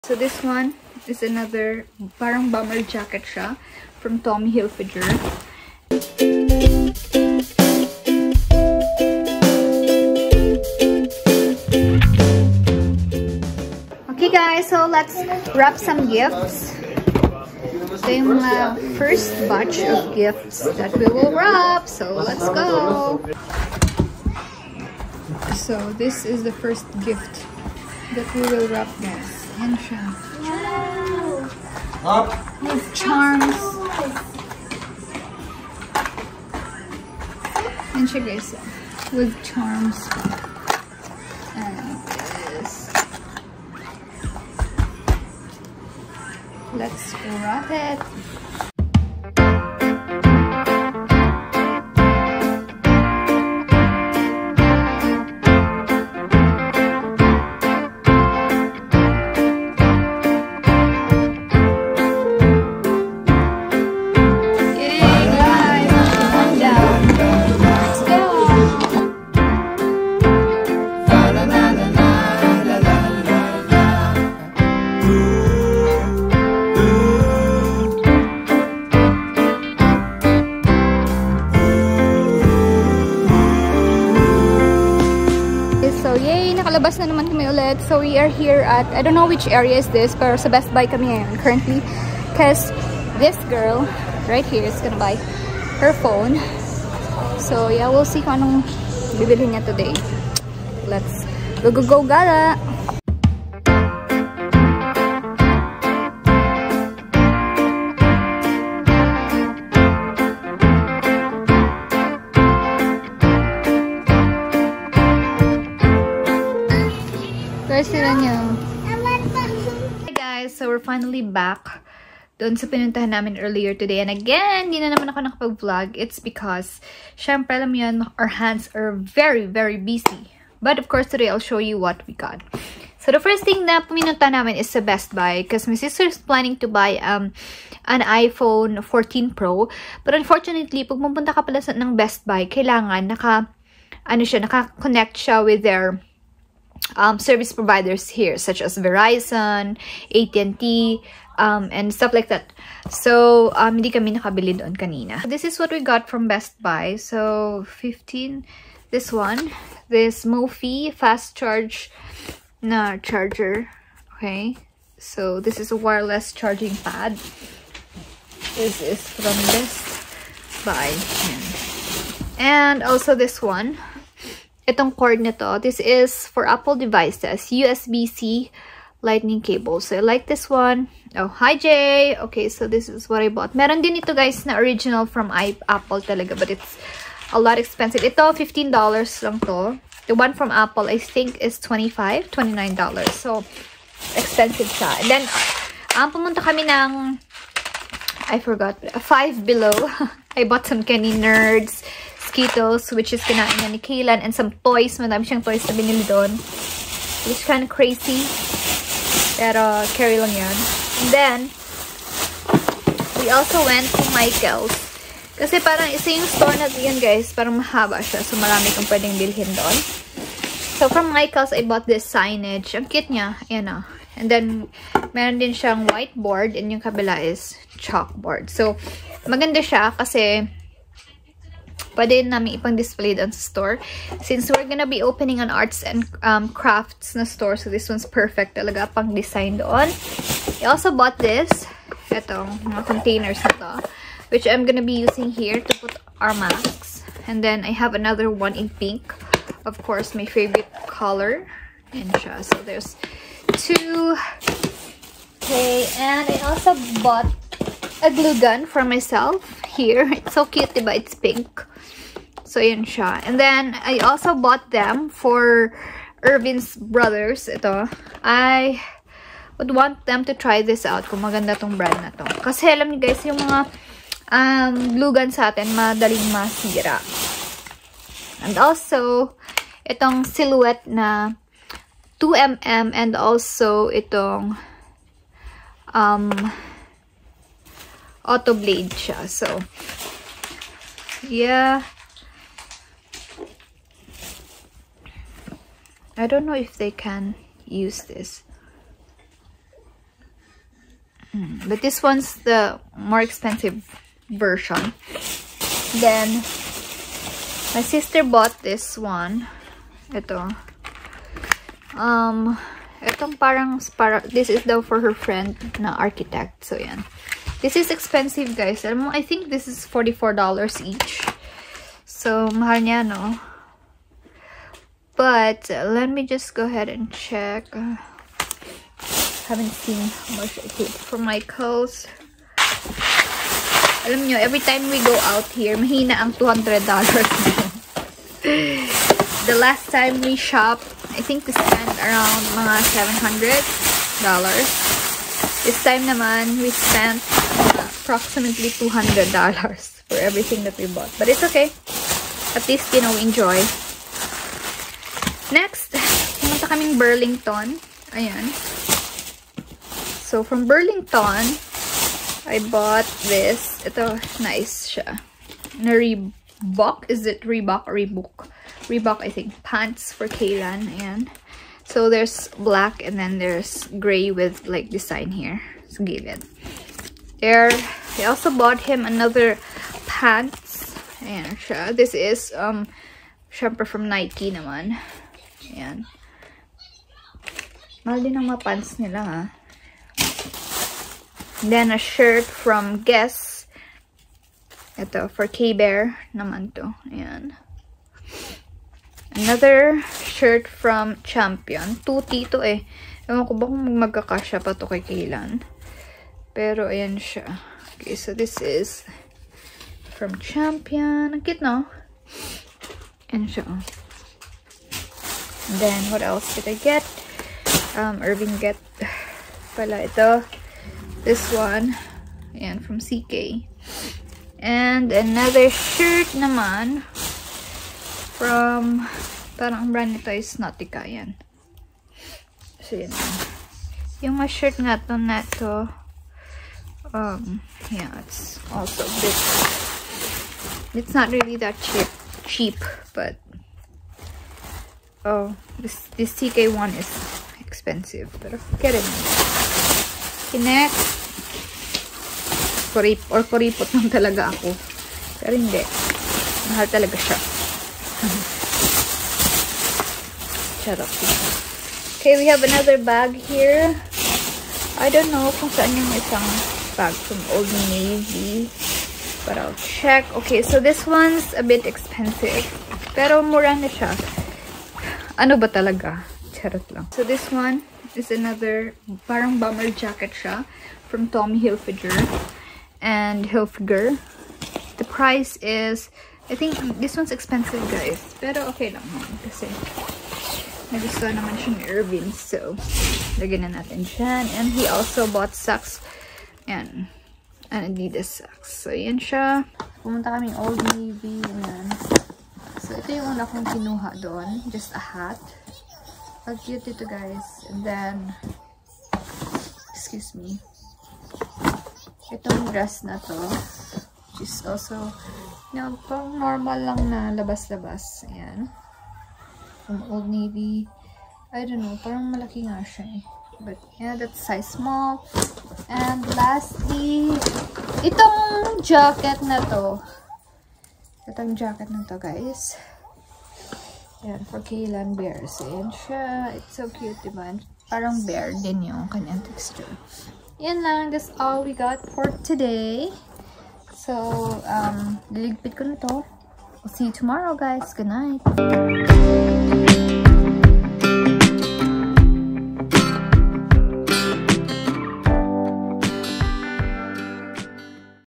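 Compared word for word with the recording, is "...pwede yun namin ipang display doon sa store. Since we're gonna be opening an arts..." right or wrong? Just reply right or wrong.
right.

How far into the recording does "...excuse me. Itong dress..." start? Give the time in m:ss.
8:29.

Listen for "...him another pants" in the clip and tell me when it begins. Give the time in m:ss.
6:18.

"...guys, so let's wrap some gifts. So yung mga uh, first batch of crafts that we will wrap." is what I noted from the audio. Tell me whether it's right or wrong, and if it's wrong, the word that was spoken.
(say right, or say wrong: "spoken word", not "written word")
wrong: "gifts", not "crafts".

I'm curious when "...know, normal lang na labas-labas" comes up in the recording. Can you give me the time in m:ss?
8:35.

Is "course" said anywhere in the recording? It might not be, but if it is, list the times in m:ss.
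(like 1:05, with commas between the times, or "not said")
2:10, 4:09.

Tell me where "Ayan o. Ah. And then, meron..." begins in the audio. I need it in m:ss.
3:43.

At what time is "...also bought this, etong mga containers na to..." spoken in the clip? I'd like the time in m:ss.
4:00.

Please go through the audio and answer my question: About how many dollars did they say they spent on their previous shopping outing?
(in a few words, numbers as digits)
$700.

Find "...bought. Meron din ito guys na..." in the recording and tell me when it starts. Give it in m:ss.
3:03.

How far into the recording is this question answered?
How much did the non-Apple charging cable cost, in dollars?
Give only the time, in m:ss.
3:08.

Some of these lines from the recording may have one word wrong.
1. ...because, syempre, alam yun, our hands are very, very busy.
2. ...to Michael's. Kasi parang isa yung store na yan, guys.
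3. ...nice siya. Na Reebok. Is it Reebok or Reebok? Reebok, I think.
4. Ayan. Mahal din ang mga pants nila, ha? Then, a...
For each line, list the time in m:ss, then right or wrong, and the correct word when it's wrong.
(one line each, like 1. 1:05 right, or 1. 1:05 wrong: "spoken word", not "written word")
1. 2:06 right
2. 3:33 right
3. 6:04 right
4. 6:25 right.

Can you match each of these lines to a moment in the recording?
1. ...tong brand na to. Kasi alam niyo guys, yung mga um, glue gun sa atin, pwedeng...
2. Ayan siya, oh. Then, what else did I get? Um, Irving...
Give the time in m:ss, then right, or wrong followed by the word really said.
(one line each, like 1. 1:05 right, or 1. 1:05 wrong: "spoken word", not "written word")
1. 4:31 wrong: "madaling", not "pwedeng"
2. 6:53 right.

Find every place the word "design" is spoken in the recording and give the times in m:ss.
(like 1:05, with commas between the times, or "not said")
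3:59, 6:14.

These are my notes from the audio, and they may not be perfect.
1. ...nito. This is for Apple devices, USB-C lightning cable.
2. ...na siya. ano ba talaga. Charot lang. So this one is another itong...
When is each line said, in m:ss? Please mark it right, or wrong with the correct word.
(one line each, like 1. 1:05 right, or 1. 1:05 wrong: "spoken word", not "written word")
1. 2:55 right
2. 7:53 wrong: "parang", not "itong".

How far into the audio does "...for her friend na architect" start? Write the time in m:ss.
5:14.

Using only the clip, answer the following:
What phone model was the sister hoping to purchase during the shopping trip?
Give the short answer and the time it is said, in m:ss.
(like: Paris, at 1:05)
iPhone 14 Pro, at 2:18.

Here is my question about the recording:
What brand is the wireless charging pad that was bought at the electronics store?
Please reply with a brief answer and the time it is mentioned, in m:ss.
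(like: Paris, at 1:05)
Mophie, at 2:40.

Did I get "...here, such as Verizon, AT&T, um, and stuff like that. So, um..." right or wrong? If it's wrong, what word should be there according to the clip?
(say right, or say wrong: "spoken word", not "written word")
right.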